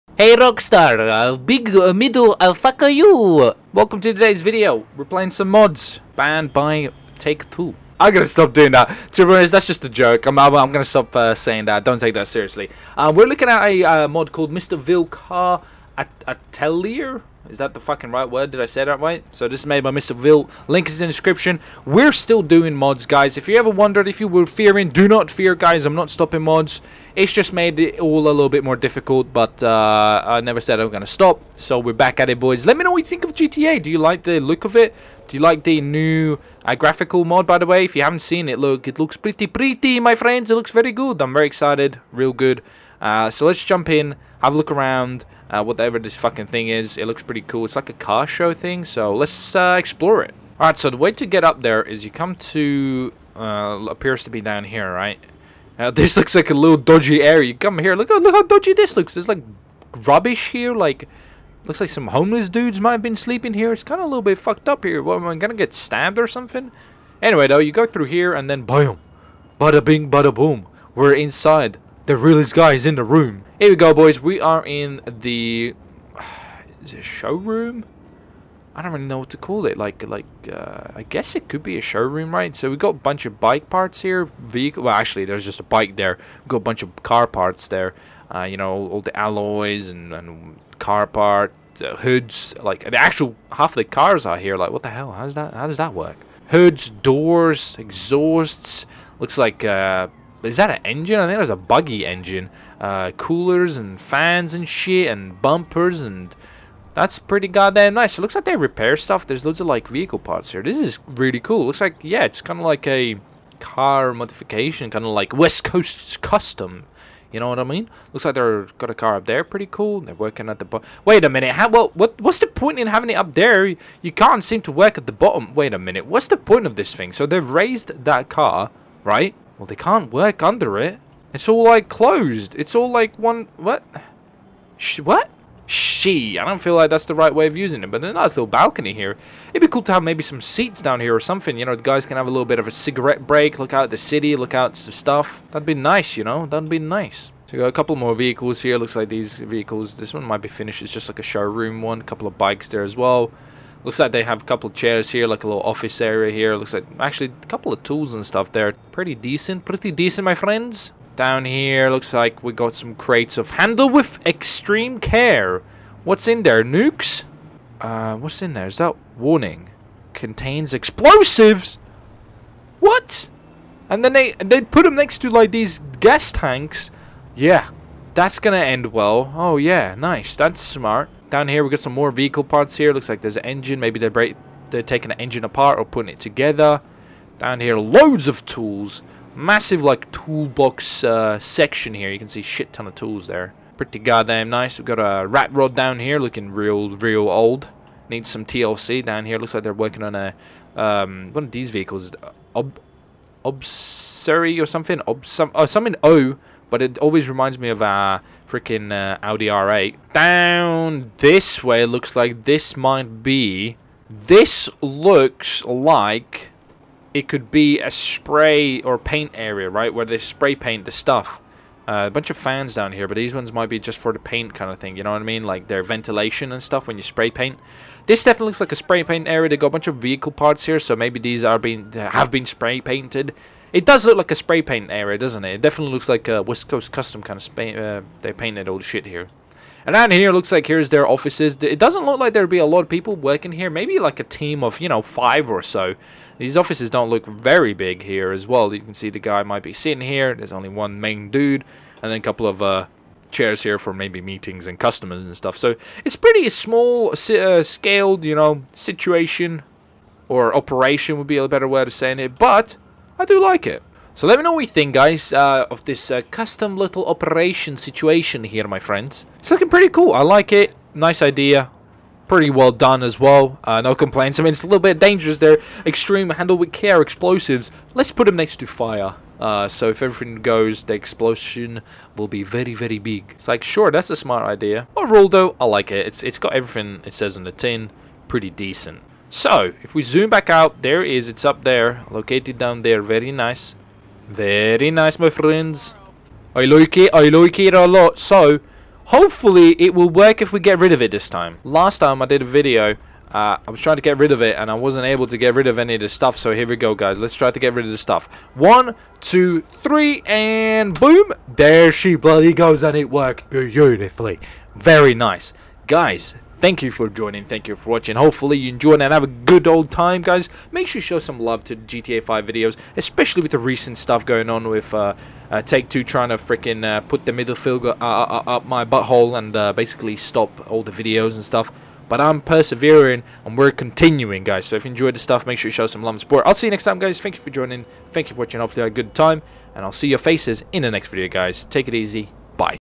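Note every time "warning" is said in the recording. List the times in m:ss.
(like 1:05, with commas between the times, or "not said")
2:49.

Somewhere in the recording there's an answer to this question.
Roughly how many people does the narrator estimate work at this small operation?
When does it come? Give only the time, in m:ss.
4:05.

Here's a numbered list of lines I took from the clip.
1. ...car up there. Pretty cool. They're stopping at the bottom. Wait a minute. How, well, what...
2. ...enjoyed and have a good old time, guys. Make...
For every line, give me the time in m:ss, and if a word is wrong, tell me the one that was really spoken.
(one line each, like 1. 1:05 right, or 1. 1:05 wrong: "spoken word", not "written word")
1. 1:58 wrong: "working", not "stopping"
2. 5:18 right.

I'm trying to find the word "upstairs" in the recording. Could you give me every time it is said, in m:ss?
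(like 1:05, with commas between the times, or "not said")
not said.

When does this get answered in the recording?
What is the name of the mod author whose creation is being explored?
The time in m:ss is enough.
0:19.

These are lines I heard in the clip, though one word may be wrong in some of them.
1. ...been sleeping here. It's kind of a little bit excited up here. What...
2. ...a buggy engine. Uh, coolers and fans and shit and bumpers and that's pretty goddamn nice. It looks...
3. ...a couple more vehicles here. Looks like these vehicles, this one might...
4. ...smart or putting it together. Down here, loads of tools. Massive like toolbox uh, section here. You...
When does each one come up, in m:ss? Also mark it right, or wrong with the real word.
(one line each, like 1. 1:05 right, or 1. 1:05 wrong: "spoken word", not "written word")
1. 1:03 wrong: "fucked", not "excited"
2. 1:41 right
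3. 2:27 right
4. 3:05 wrong: "apart", not "smart".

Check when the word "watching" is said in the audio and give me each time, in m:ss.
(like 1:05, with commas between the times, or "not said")
5:17, 5:38.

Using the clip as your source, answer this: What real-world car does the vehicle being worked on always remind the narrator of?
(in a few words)
Audi R8.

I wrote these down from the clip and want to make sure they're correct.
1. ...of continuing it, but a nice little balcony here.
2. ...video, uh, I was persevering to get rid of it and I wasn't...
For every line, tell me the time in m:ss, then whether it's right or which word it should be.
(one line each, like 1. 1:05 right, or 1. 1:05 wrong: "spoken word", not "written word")
1. 2:17 wrong: "using", not "continuing"
2. 5:02 wrong: "trying", not "persevering".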